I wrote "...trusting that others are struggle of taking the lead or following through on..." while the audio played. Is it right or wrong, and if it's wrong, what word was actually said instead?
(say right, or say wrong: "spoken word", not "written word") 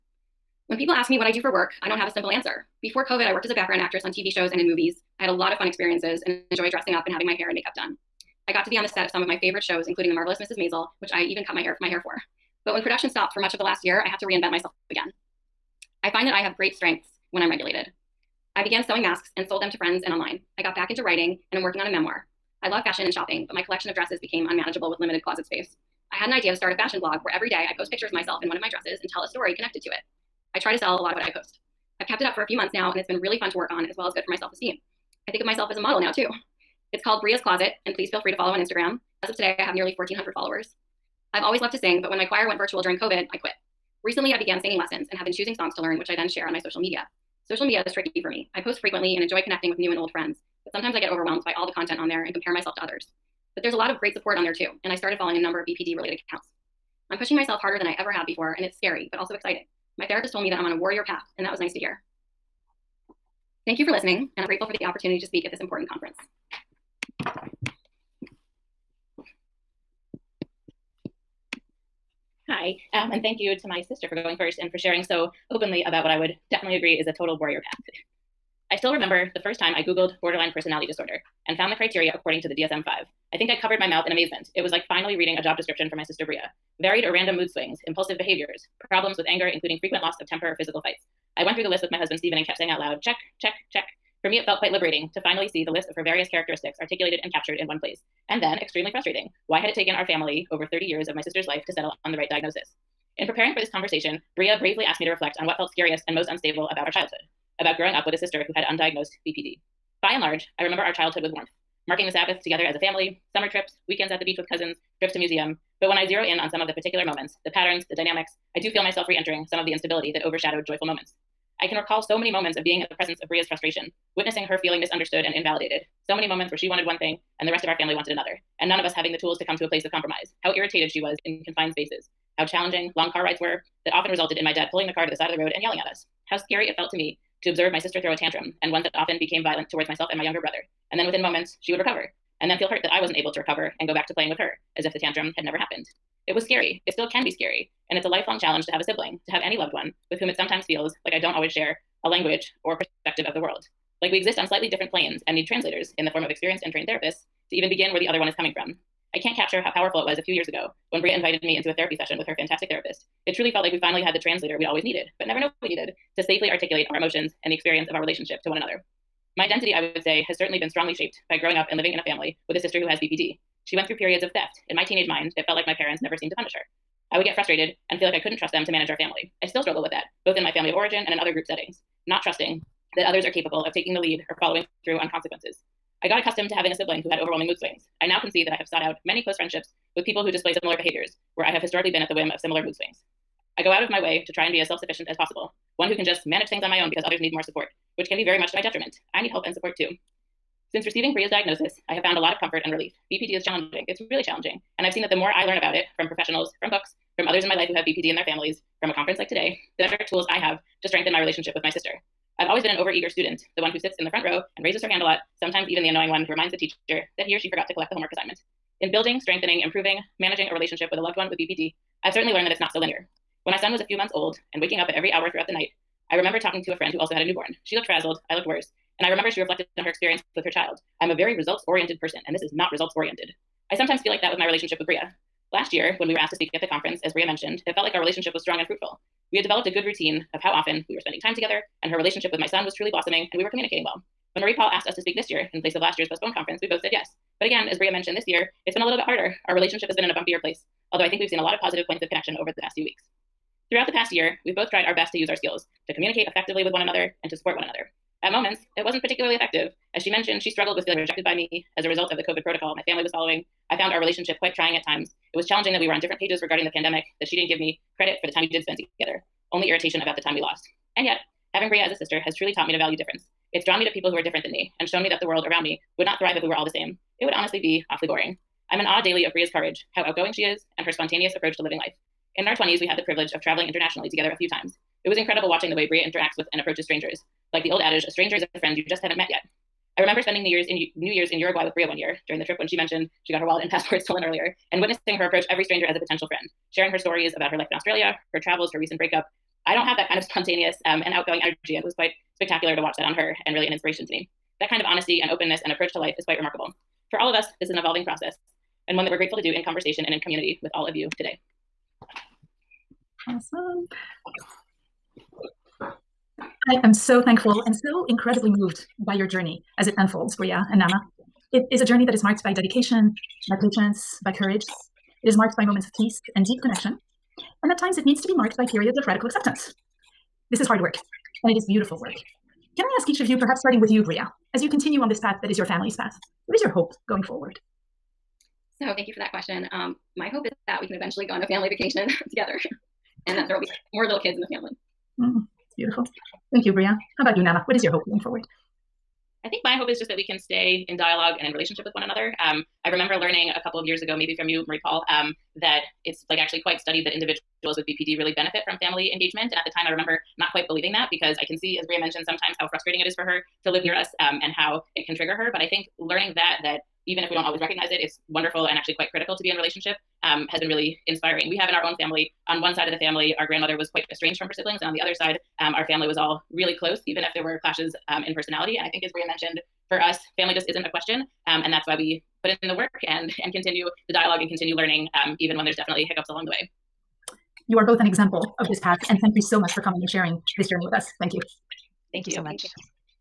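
wrong: "capable", not "struggle".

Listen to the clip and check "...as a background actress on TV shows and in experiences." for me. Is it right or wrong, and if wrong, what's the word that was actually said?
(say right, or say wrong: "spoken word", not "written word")
wrong: "movies", not "experiences".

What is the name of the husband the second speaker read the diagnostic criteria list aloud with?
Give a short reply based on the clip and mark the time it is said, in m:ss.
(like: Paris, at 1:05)
Stephen, at 1:32.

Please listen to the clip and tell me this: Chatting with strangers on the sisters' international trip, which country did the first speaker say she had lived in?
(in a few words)
Australia.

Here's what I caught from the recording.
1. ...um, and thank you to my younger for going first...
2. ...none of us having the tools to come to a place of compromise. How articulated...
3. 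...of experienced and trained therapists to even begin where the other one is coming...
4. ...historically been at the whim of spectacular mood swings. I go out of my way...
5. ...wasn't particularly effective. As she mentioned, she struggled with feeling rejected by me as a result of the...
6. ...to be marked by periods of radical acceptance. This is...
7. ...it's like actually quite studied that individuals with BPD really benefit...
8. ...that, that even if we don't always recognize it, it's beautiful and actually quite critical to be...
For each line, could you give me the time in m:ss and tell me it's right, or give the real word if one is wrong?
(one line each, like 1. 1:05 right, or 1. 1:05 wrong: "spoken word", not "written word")
1. 1:12 wrong: "sister", not "younger"
2. 2:08 wrong: "irritated", not "articulated"
3. 2:36 right
4. 3:11 wrong: "similar", not "spectacular"
5. 4:18 right
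6. 5:28 right
7. 5:56 right
8. 6:06 wrong: "wonderful", not "beautiful".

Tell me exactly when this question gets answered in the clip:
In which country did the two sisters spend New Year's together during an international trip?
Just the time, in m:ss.
4:51.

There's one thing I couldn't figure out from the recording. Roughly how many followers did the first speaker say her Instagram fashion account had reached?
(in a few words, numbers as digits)
1,400.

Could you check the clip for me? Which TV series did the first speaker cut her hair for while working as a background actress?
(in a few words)
The Marvelous Mrs. Maisel.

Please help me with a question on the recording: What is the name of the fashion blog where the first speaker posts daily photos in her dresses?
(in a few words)
Bria's Closet.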